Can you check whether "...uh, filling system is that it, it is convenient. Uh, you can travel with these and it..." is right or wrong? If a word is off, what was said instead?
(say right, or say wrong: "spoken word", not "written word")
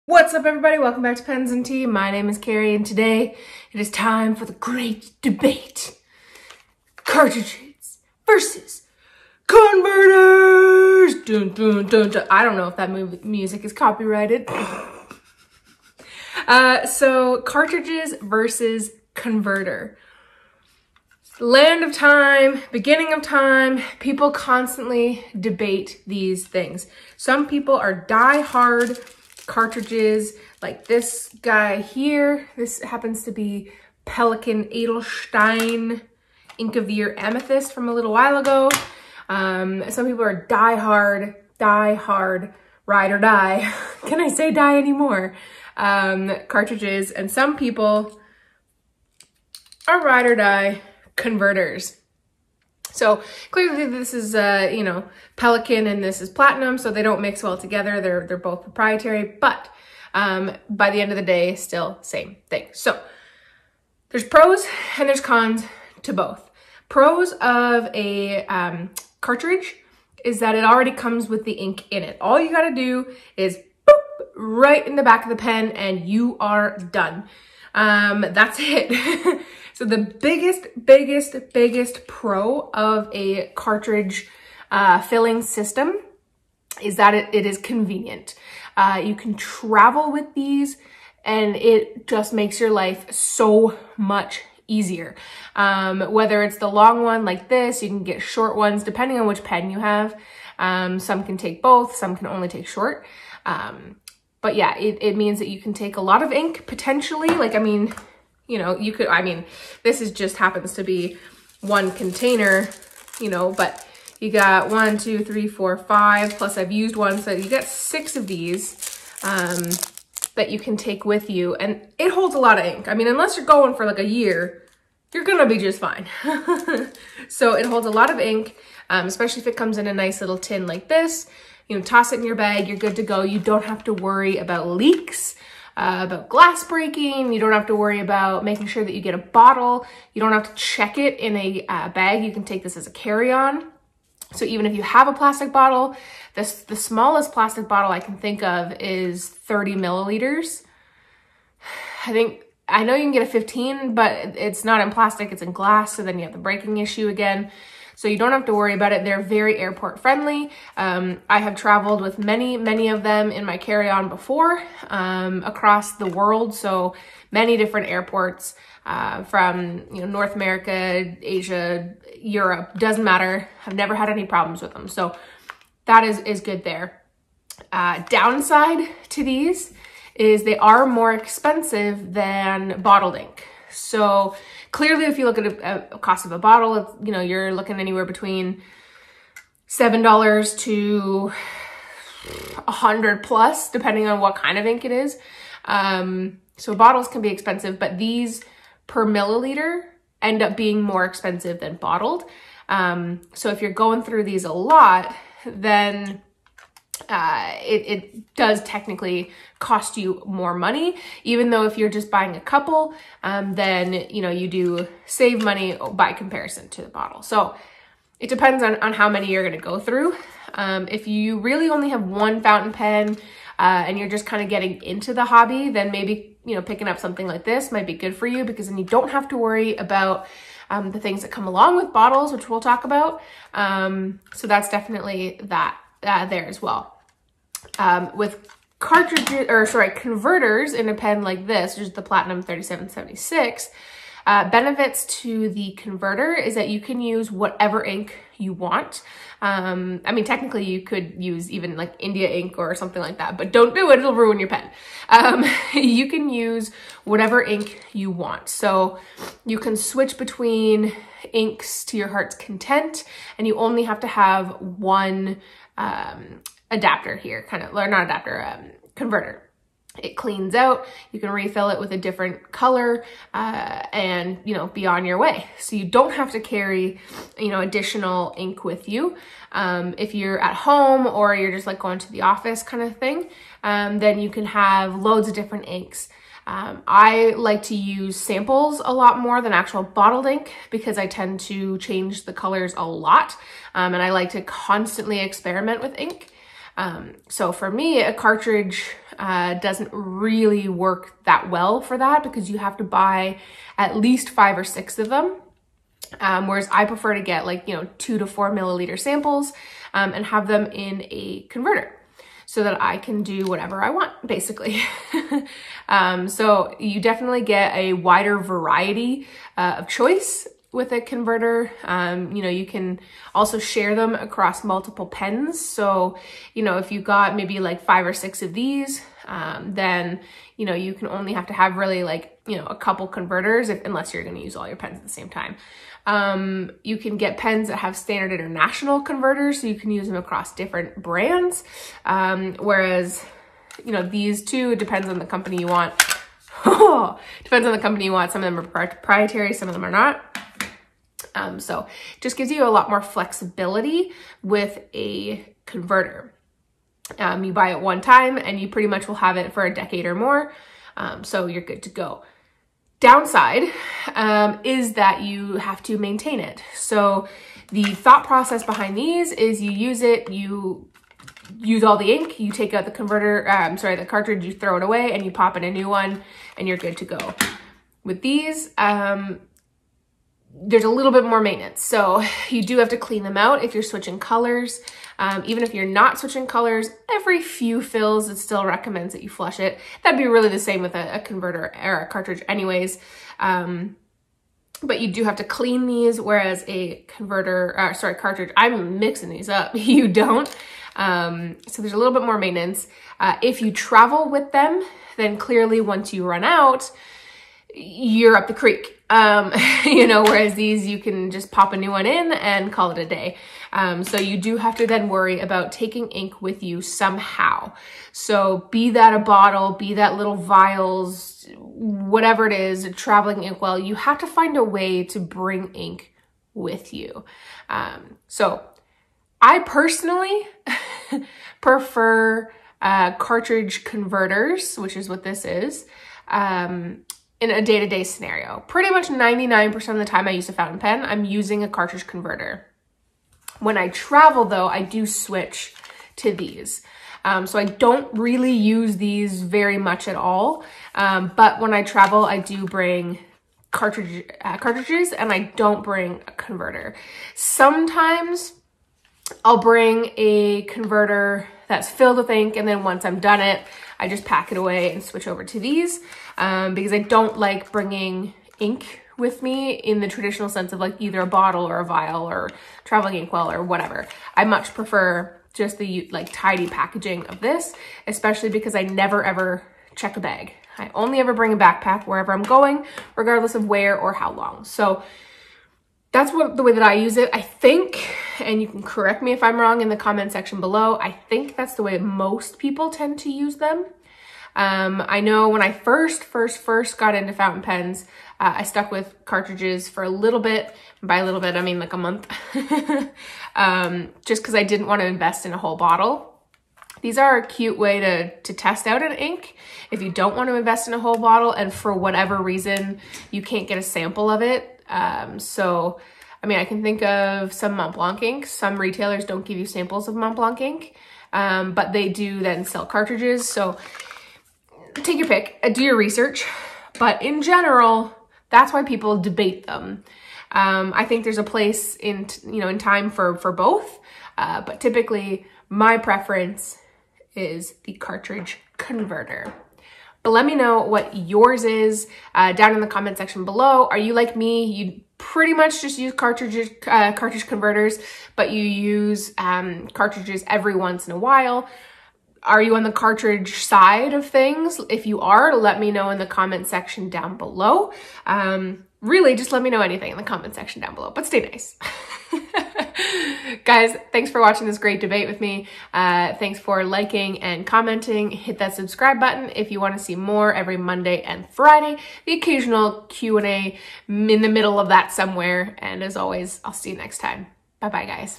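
right.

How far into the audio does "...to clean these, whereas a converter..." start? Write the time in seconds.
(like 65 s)
395 s.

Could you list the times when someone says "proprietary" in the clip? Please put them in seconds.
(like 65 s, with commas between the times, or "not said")
58 s, 348 s.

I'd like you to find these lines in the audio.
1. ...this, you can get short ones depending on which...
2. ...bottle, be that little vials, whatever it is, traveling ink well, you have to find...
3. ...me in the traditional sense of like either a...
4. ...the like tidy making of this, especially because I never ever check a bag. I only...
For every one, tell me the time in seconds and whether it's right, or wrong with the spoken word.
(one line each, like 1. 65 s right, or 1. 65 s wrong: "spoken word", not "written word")
1. 97 s right
2. 419 s right
3. 469 s right
4. 475 s wrong: "packaging", not "making".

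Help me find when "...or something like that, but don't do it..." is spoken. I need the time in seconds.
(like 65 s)
252 s.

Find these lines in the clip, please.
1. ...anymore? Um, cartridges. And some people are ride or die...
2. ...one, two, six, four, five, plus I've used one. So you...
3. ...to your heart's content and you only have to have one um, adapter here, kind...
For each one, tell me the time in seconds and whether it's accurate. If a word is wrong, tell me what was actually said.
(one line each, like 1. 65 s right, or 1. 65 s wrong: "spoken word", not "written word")
1. 44 s right
2. 114 s wrong: "three", not "six"
3. 261 s right.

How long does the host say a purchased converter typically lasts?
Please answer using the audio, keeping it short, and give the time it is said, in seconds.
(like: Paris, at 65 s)
a decade or more, at 359 s.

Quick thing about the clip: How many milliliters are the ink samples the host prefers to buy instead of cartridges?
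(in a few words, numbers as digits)
2 to 4.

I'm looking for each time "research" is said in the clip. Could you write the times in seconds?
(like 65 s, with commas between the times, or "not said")
525 s.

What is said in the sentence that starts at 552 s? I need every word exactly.
Are you on the cartridge side of things?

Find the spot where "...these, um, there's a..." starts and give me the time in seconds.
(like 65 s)
378 s.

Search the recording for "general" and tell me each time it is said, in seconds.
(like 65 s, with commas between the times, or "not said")
527 s.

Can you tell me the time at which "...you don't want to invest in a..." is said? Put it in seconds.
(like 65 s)
510 s.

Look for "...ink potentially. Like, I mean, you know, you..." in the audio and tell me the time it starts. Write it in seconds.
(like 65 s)
106 s.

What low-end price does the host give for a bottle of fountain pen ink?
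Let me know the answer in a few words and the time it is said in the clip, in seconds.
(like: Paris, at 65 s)
$7, at 189 s.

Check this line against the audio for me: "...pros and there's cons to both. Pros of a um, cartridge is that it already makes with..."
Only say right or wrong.
wrong.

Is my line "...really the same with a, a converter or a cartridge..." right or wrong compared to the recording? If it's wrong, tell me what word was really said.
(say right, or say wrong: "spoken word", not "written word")
right.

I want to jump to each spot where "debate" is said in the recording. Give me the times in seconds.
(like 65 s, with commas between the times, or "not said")
5 s, 25 s, 529 s, 565 s.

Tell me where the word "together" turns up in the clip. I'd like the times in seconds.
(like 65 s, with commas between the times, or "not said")
57 s.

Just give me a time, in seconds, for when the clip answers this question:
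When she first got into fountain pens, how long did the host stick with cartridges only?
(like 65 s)
501 s.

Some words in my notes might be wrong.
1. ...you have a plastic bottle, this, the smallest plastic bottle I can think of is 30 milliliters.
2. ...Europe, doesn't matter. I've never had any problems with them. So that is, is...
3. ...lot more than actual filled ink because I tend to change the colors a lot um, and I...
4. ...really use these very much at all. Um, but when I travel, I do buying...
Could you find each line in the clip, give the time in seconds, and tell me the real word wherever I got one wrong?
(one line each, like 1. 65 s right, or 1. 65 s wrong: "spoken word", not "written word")
1. 144 s right
2. 172 s right
3. 288 s wrong: "bottled", not "filled"
4. 448 s wrong: "bring", not "buying".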